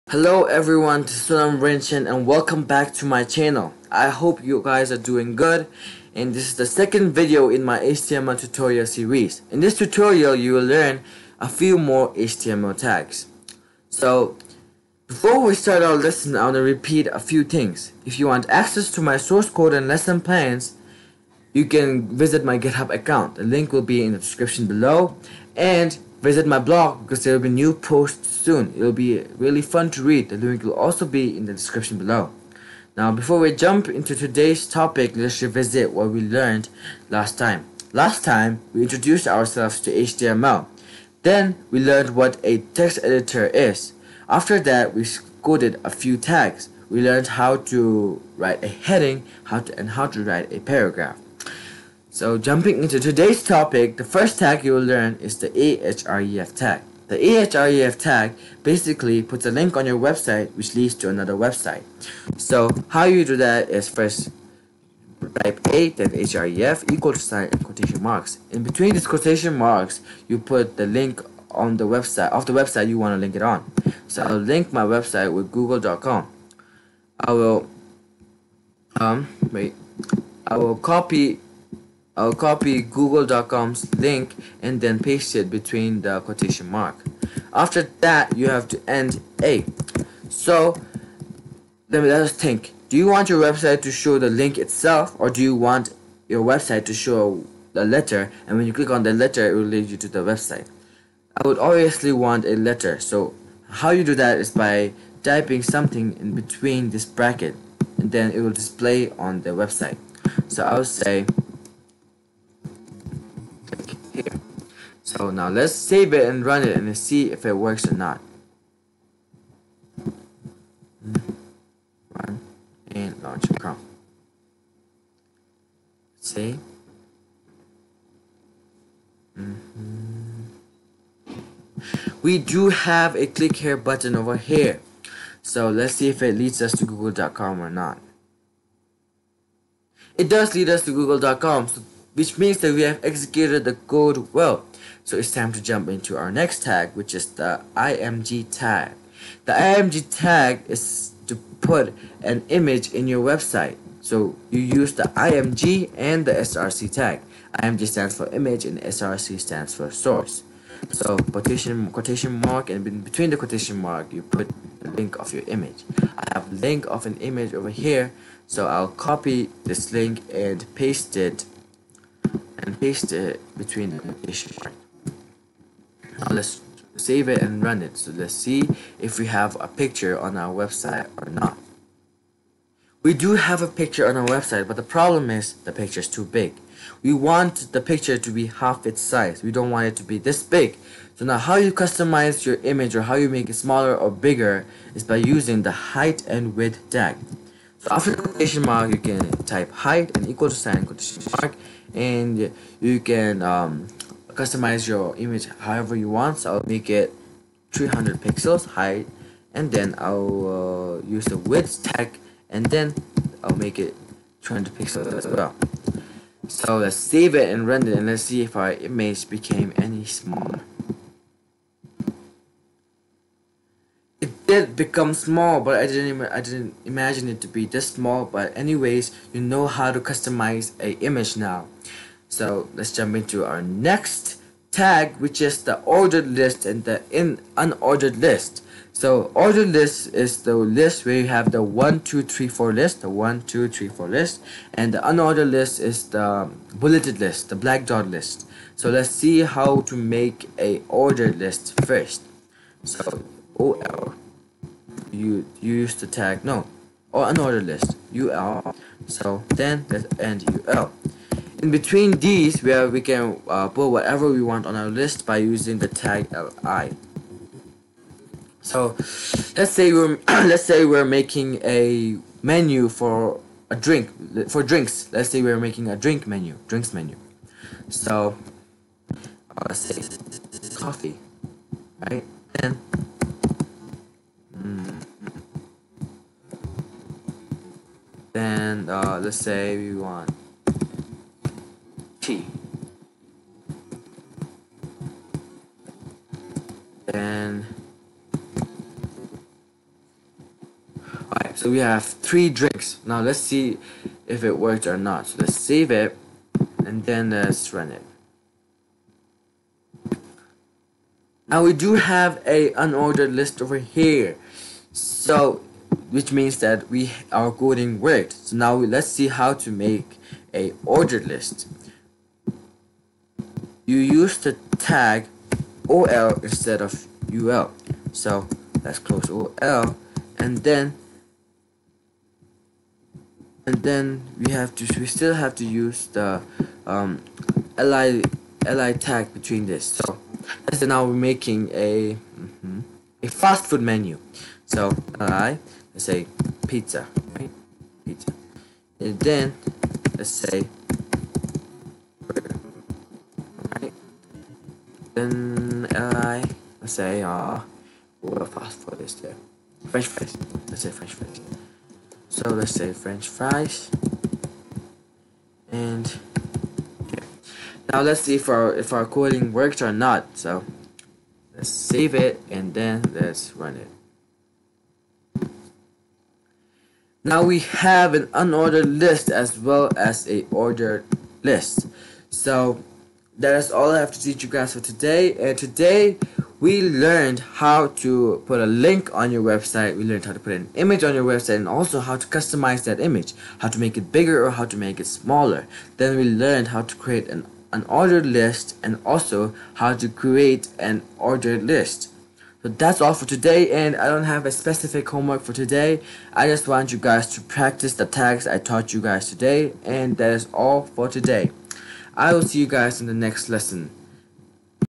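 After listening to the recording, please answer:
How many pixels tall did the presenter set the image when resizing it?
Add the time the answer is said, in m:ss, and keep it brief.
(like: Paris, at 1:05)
300, at 3:26.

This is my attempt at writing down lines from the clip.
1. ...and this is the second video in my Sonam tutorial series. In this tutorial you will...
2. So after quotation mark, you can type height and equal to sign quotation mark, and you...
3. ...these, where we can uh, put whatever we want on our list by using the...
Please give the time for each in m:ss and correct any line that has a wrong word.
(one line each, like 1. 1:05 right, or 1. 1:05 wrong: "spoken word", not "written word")
1. 0:06 wrong: "HTML", not "Sonam"
2. 3:17 right
3. 4:22 right.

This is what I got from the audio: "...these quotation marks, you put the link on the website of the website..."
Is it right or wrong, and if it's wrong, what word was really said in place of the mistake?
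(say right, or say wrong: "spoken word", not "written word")
right.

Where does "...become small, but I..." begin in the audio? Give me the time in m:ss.
3:44.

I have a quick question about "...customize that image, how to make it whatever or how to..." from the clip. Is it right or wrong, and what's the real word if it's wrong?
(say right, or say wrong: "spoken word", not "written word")
wrong: "bigger", not "whatever".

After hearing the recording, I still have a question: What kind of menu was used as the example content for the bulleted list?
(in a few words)
drinks menu.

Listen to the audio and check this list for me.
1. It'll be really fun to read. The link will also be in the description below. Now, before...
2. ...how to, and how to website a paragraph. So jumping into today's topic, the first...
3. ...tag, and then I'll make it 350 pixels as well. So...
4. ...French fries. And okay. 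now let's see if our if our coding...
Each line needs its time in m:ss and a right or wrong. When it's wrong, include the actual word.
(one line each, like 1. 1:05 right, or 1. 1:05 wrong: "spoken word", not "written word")
1. 0:28 right
2. 0:49 wrong: "write", not "website"
3. 3:31 wrong: "300", not "350"
4. 6:02 right.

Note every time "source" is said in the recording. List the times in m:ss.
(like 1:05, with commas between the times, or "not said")
0:19, 2:39.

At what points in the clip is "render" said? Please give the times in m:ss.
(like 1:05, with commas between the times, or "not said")
3:37.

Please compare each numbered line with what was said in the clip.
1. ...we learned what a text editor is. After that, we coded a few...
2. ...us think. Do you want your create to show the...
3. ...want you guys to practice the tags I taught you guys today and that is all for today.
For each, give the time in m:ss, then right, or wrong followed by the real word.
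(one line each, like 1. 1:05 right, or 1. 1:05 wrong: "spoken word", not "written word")
1. 0:41 right
2. 1:32 wrong: "website", not "create"
3. 6:46 right.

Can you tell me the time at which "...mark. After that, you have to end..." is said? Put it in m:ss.
1:26.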